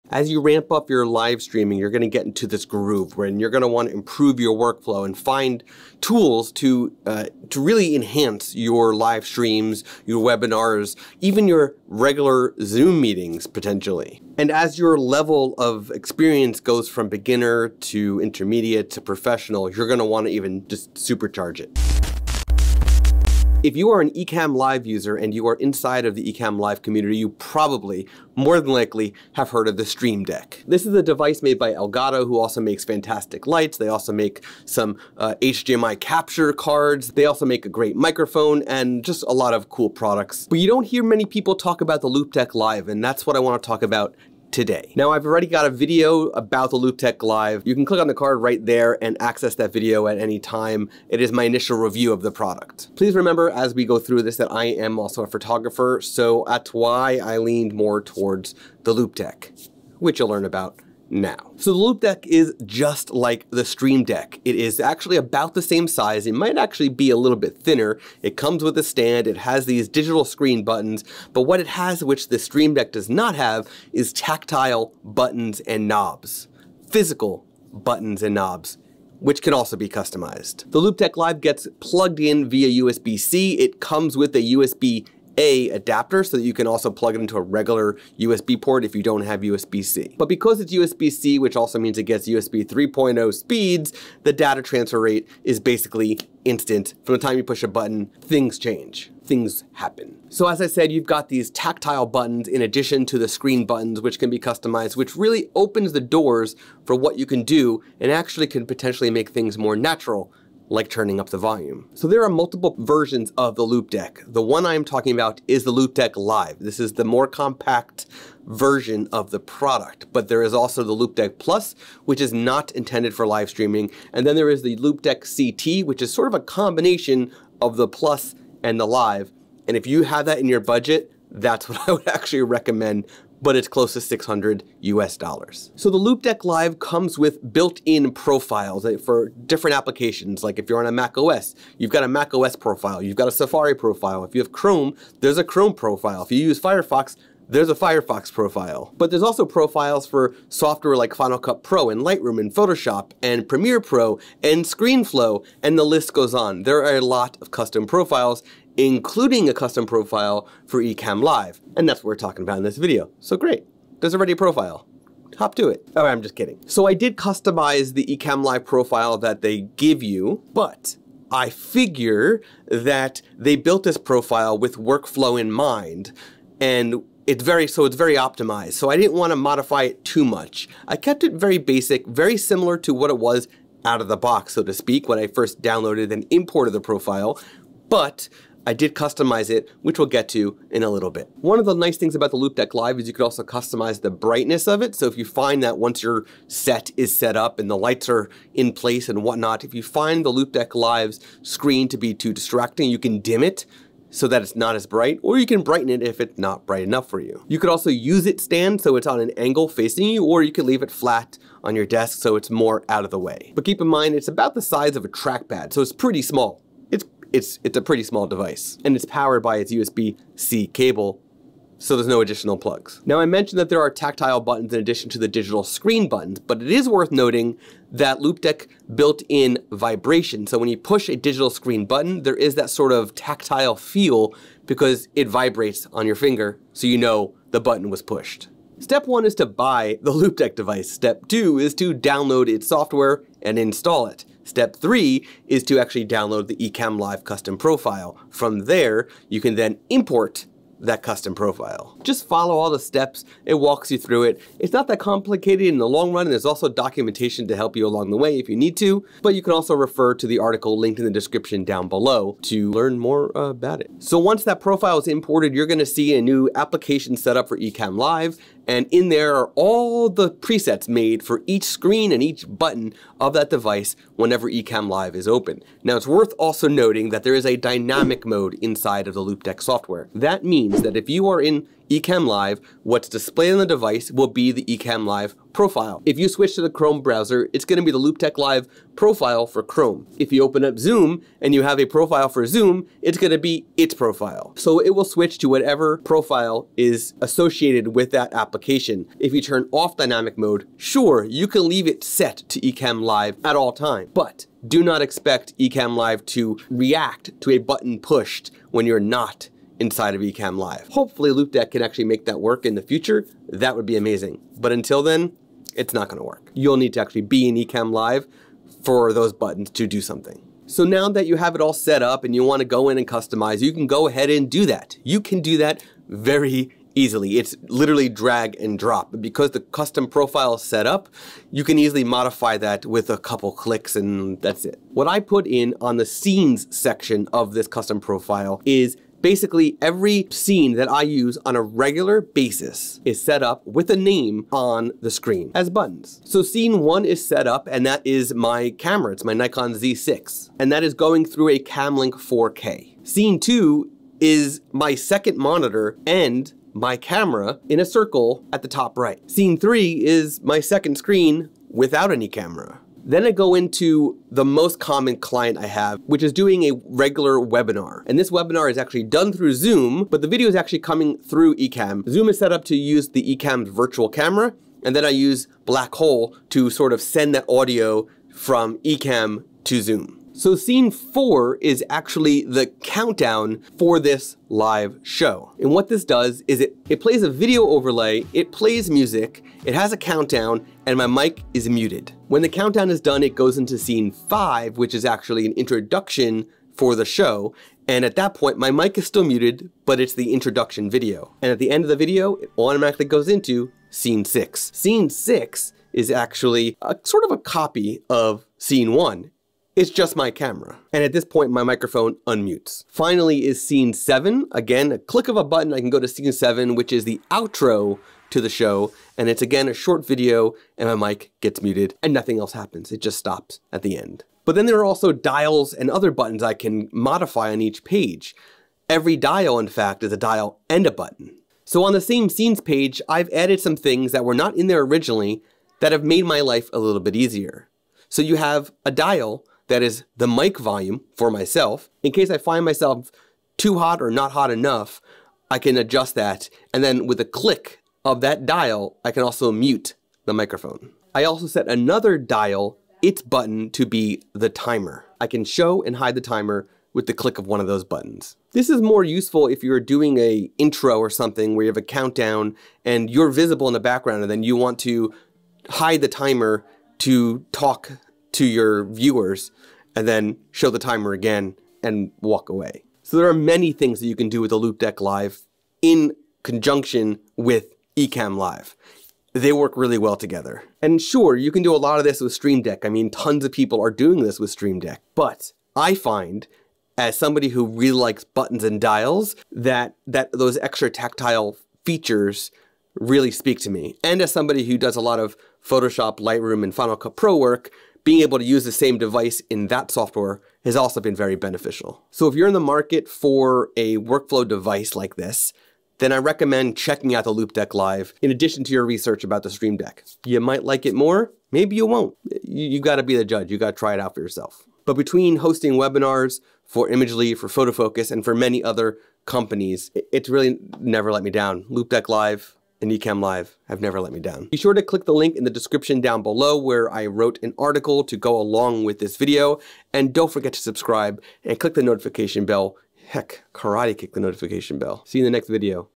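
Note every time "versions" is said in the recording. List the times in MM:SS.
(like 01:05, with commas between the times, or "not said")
01:52, 01:58.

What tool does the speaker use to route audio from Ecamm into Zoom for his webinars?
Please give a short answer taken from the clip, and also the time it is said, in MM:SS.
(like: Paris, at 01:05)
Black Hole, at 06:15.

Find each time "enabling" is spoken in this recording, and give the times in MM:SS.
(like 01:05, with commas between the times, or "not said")
not said.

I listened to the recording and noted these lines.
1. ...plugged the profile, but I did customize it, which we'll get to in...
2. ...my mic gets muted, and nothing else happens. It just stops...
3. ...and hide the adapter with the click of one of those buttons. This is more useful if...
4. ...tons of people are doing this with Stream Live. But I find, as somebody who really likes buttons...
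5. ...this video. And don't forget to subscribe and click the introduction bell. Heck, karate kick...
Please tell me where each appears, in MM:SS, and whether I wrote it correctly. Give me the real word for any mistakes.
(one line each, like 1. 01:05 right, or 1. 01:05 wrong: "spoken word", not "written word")
1. 03:06 wrong: "imported", not "plugged"
2. 07:00 right
3. 07:35 wrong: "timer", not "adapter"
4. 08:03 wrong: "Deck", not "Live"
5. 08:48 wrong: "notification", not "introduction".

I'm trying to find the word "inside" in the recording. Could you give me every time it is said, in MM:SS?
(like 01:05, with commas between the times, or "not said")
00:25, 04:38, 05:09.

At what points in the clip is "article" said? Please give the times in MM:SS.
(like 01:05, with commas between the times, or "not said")
04:20, 08:47.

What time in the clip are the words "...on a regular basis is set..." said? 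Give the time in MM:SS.
05:41.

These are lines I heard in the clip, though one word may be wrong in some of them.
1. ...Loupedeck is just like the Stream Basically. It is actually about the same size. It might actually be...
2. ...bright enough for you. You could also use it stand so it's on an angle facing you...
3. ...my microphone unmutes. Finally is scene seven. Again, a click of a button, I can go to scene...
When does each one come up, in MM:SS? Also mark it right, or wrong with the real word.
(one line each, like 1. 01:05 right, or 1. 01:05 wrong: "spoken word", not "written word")
1. 01:01 wrong: "Deck", not "Basically"
2. 03:26 right
3. 06:51 right.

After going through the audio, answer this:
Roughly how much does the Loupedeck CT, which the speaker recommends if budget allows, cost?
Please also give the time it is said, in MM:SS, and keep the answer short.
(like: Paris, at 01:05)
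600 US dollars, at 02:14.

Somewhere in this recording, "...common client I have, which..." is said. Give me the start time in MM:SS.
06:04.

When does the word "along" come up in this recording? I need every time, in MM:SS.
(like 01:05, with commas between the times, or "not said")
04:17, 08:48.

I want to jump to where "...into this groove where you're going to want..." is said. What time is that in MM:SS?
00:02.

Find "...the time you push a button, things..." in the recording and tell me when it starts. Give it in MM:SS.
01:37.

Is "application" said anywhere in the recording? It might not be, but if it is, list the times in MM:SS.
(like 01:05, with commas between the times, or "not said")
02:19, 04:26, 04:58.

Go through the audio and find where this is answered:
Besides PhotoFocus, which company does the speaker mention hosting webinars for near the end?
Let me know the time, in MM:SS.
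08:36.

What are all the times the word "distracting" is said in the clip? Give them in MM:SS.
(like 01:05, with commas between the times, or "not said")
03:22.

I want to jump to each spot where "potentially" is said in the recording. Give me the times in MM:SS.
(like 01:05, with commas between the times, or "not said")
00:13, 01:48.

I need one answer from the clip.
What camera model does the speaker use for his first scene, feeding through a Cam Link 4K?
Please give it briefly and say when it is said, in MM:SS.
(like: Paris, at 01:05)
Nikon Z6, at 05:49.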